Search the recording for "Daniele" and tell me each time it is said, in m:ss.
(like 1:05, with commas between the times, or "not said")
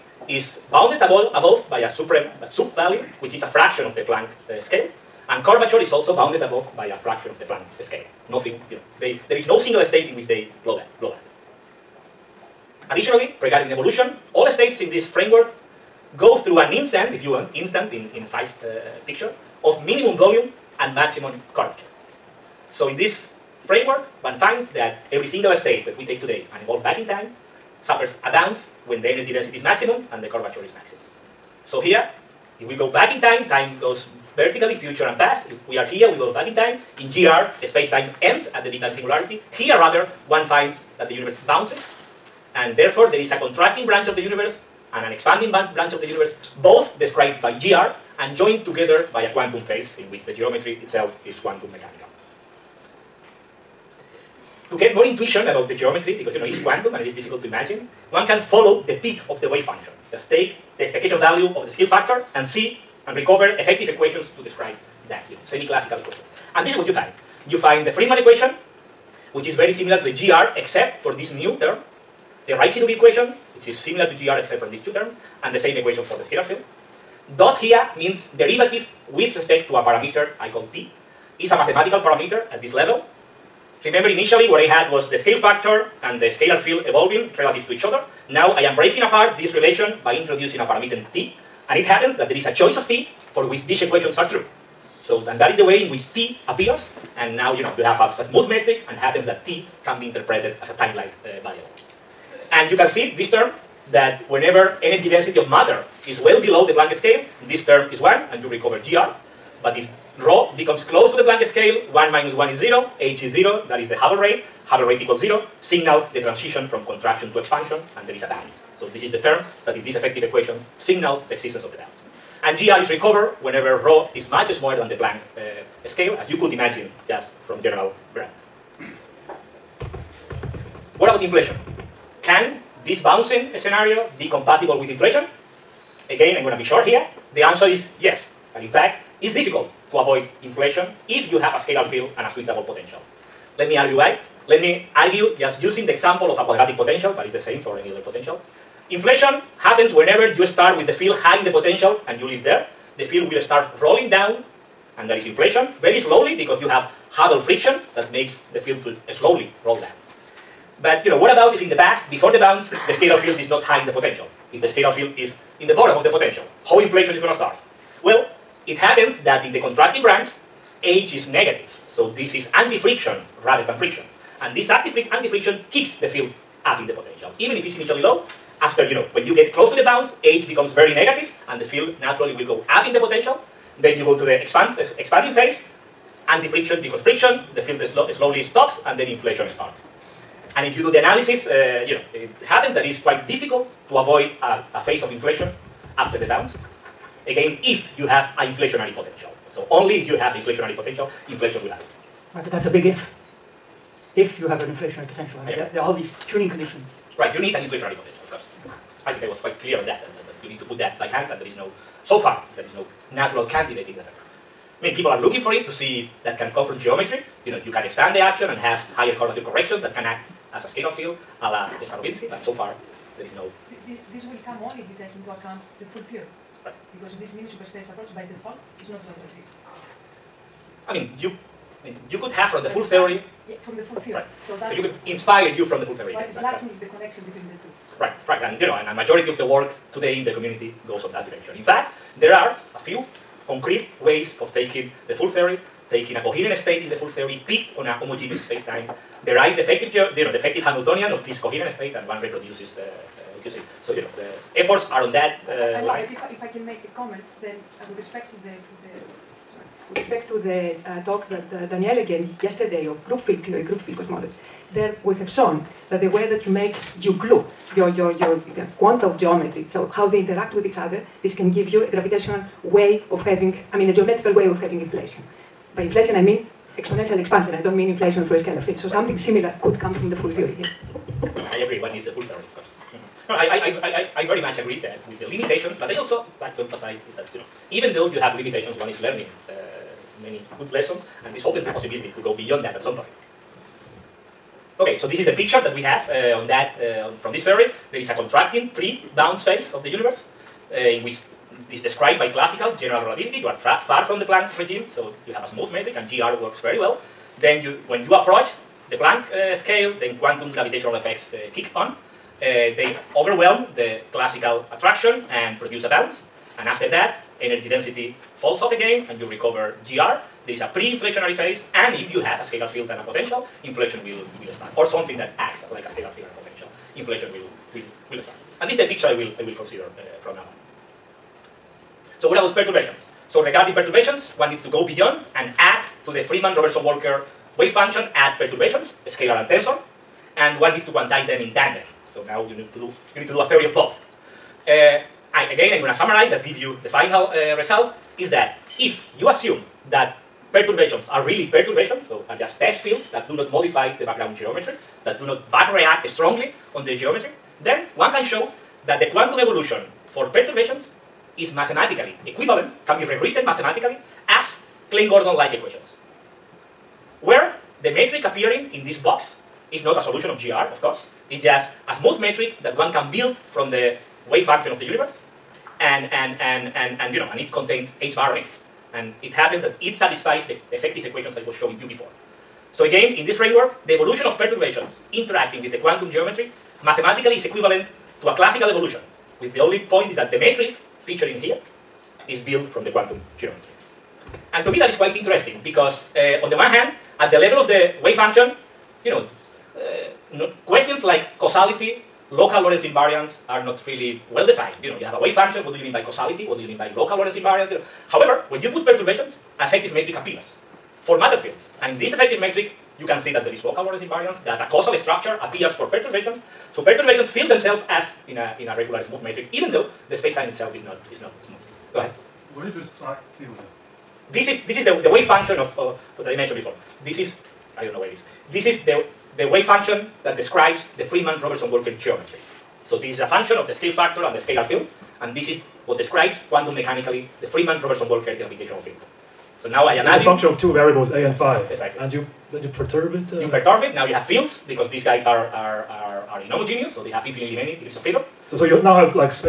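4:21.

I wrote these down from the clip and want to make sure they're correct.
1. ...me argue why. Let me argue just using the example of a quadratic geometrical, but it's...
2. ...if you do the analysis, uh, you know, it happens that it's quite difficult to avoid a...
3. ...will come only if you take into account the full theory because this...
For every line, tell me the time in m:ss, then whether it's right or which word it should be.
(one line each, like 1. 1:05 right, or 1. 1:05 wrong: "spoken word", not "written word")
1. 2:23 wrong: "potential", not "geometrical"
2. 3:10 right
3. 3:44 right.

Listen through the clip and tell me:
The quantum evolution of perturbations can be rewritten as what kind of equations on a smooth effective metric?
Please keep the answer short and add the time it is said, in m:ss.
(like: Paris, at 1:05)
Klein-Gordon-like equations, at 6:04.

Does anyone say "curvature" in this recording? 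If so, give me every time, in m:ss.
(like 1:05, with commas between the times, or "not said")
0:05, 0:21, 0:30, 3:39.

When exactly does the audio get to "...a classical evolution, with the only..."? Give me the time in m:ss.
6:28.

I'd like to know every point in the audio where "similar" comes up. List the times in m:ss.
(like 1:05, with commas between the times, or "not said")
1:09, 1:13, 4:39.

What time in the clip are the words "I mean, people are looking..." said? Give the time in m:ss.
3:34.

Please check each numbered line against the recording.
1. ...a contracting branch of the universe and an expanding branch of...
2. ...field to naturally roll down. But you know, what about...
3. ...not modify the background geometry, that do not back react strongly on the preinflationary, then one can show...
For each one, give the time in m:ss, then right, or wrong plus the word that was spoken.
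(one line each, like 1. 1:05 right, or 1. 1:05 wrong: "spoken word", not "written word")
1. 0:43 right
2. 2:38 wrong: "slowly", not "naturally"
3. 5:53 wrong: "geometry", not "preinflationary".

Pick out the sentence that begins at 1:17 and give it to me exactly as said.
Dot here means derivative with respect to a parameter I call t.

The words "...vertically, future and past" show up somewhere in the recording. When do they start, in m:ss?
0:34.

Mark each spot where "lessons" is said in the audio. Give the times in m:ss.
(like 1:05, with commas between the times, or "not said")
4:50.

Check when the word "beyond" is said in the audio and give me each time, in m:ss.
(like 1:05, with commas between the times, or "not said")
4:52, 5:34.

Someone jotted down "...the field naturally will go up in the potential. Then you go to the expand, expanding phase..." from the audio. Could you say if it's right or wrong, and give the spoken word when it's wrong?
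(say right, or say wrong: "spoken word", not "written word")
right.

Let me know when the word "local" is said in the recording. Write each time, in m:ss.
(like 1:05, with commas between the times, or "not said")
6:42, 6:46, 6:53.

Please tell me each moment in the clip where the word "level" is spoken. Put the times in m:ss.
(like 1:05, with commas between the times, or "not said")
1:22, 6:37.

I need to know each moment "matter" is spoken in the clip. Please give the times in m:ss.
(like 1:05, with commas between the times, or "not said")
1:45, 6:51.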